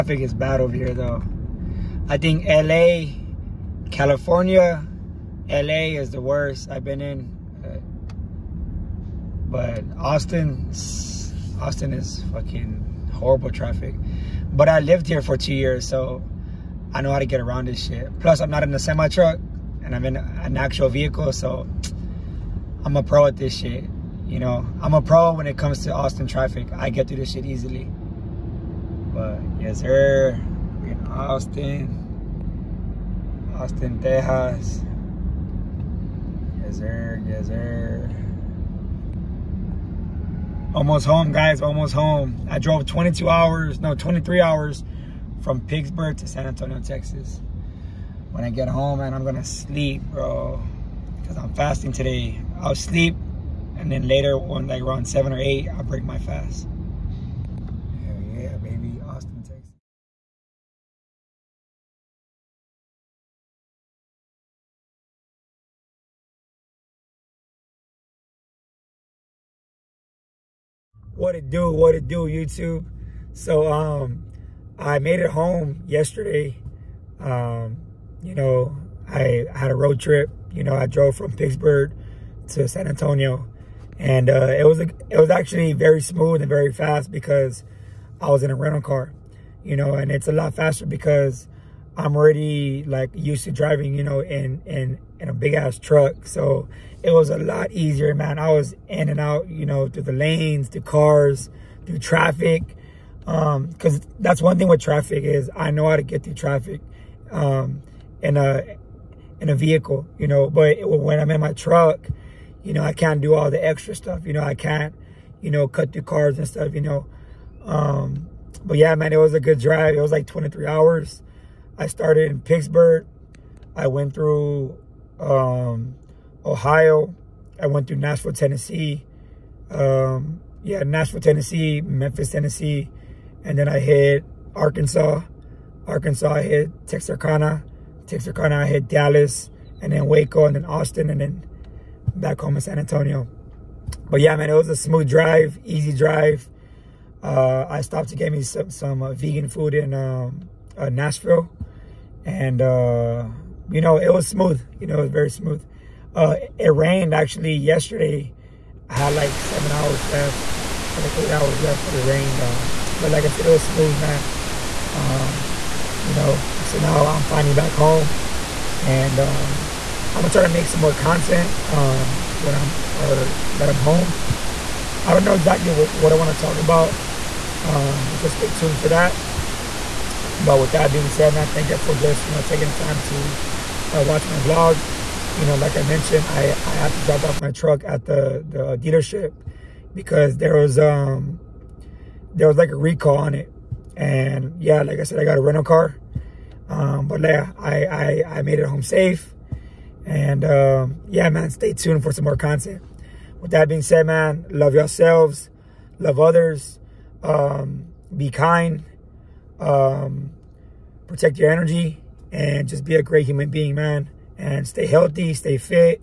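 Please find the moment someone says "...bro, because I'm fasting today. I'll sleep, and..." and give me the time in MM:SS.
00:50.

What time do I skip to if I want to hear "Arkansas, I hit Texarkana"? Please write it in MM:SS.
02:15.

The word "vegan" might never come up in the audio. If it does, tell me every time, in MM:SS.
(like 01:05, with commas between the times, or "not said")
02:29.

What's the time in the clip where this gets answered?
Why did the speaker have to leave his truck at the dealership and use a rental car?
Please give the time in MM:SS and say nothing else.
03:12.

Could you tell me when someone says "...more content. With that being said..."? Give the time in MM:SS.
03:22.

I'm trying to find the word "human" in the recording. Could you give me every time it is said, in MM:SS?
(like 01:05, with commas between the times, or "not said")
03:33.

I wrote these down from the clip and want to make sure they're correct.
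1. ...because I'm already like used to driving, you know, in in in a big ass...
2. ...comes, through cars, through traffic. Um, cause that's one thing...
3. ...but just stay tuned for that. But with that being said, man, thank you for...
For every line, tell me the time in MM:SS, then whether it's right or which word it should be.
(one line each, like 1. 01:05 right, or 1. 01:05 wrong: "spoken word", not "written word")
1. 01:30 right
2. 01:40 wrong: "lanes", not "comes"
3. 02:58 right.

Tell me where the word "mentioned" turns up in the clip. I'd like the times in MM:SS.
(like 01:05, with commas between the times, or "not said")
03:05.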